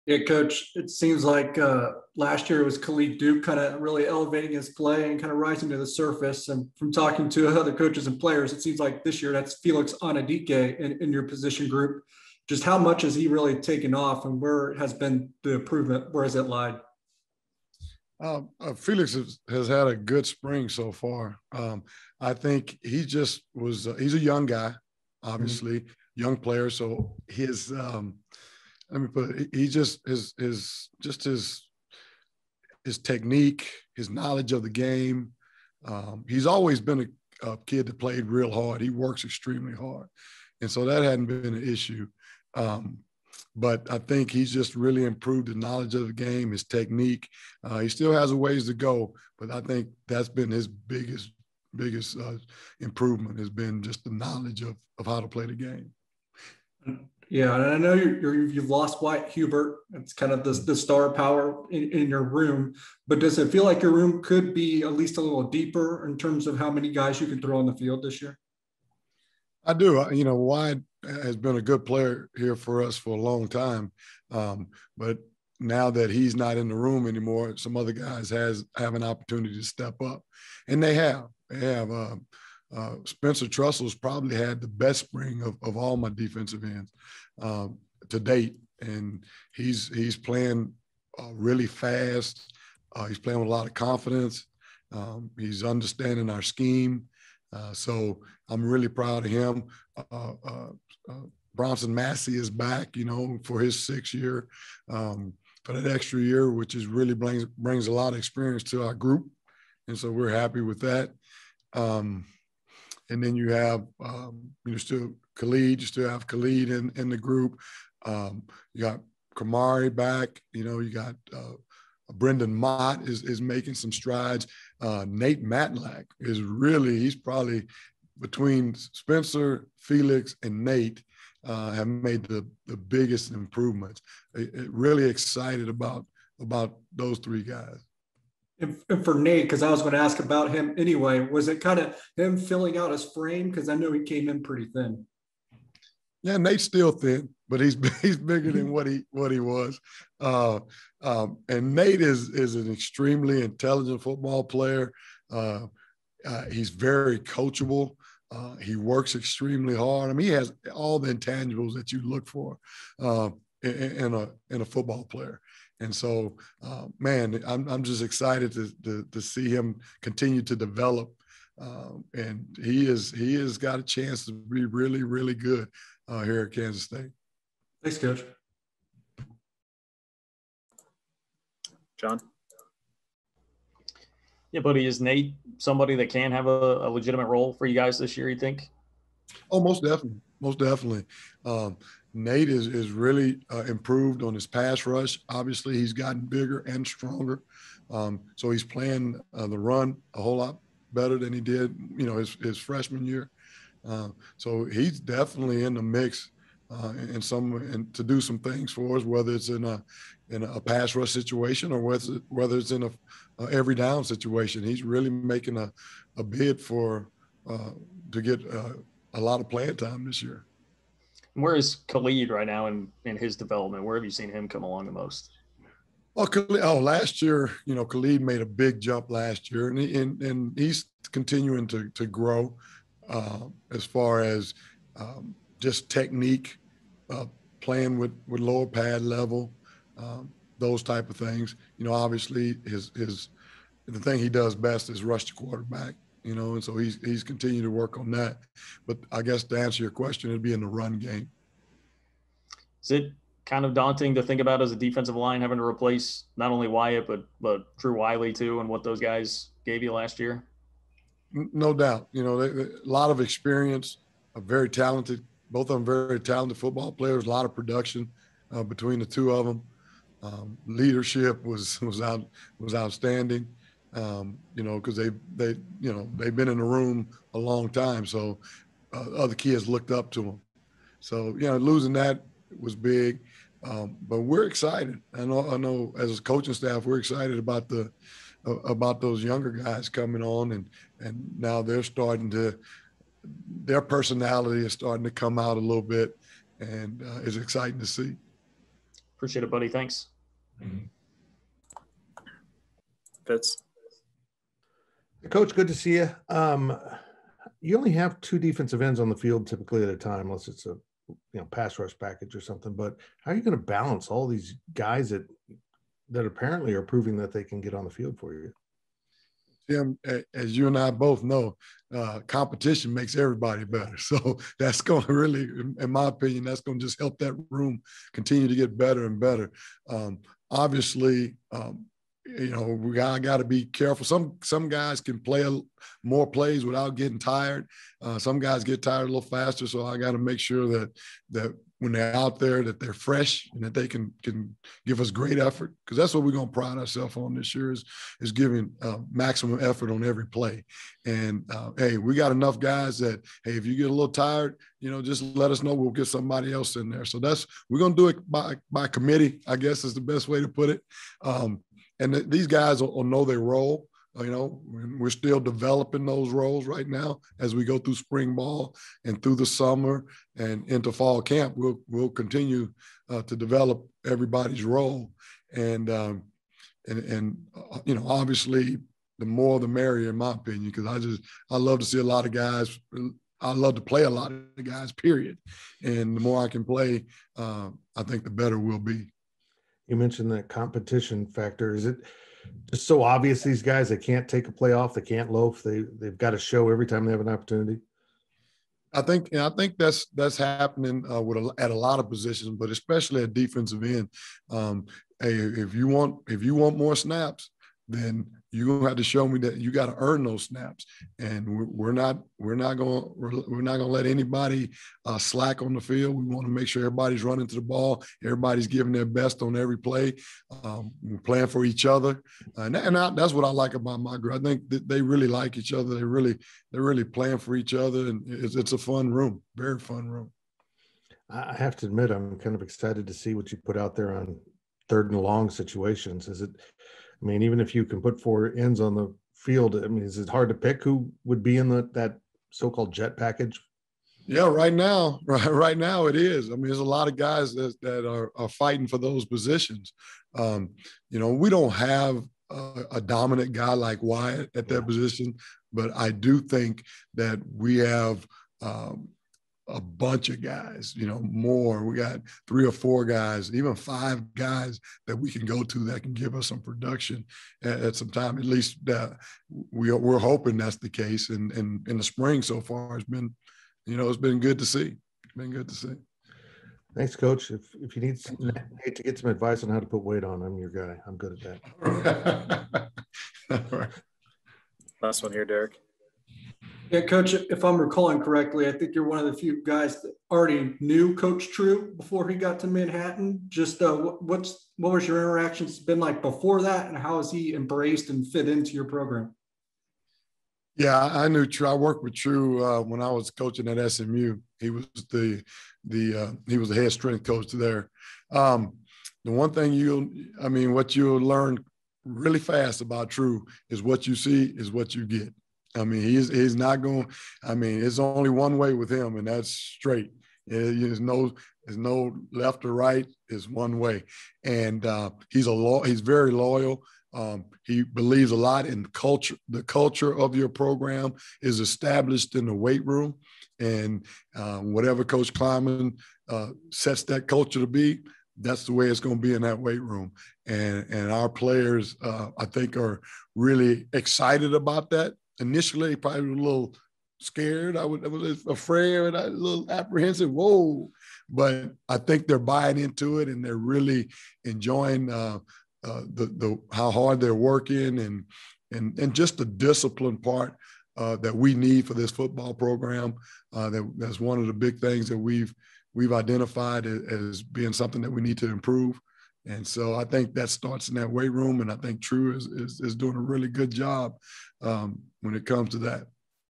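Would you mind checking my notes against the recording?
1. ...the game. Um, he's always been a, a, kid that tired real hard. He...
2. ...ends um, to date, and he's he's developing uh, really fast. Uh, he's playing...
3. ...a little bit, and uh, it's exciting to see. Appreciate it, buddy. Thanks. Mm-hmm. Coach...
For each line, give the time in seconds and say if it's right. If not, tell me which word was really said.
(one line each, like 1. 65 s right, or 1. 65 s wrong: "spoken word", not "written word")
1. 34 s wrong: "played", not "tired"
2. 86 s wrong: "playing", not "developing"
3. 295 s right.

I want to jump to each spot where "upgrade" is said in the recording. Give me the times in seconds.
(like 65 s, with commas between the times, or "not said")
not said.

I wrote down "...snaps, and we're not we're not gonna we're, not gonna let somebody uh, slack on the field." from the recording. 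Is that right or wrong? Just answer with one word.
wrong.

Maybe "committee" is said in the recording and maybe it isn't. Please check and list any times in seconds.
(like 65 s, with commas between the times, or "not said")
358 s.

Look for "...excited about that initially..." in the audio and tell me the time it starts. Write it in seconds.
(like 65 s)
543 s.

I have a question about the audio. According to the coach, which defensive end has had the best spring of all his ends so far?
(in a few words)
Spencer Trussell.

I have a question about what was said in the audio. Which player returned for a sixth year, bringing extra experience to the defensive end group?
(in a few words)
Bronson Massey.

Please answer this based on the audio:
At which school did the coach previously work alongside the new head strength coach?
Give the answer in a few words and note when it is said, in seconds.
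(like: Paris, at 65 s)
SMU, at 503 s.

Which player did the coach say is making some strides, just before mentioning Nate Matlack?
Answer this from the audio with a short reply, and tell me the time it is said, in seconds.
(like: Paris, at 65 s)
Brendan Mott, at 122 s.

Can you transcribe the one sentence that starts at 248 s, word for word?
But I guess to answer your question, it'd be in the run game.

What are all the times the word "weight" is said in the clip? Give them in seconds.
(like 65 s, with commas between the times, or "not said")
480 s, 532 s, 539 s, 571 s.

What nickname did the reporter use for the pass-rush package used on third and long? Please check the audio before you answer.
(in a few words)
jet package.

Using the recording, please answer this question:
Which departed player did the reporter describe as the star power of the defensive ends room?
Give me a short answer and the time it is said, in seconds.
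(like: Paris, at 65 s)
Wyatt Hubert, at 59 s.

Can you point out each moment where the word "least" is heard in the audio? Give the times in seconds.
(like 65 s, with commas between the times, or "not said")
64 s, 468 s.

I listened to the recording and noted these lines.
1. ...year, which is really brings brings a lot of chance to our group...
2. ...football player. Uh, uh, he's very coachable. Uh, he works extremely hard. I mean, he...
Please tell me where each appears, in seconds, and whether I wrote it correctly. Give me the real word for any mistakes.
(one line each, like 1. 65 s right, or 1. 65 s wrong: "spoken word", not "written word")
1. 106 s wrong: "experience", not "chance"
2. 154 s right.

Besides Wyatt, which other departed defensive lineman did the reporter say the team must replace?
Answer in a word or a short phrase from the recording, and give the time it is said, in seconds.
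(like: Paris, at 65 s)
Drew Wiley, at 257 s.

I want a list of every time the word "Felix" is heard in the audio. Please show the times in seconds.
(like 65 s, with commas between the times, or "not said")
9 s, 18 s, 129 s.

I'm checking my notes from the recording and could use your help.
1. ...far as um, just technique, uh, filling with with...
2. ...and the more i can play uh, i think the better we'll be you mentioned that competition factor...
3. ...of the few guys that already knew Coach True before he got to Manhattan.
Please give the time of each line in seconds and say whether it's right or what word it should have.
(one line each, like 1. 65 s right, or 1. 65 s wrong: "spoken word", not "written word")
1. 233 s wrong: "playing", not "filling"
2. 385 s right
3. 489 s right.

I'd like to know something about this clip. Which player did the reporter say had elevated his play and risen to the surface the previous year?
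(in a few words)
Khalid Duke.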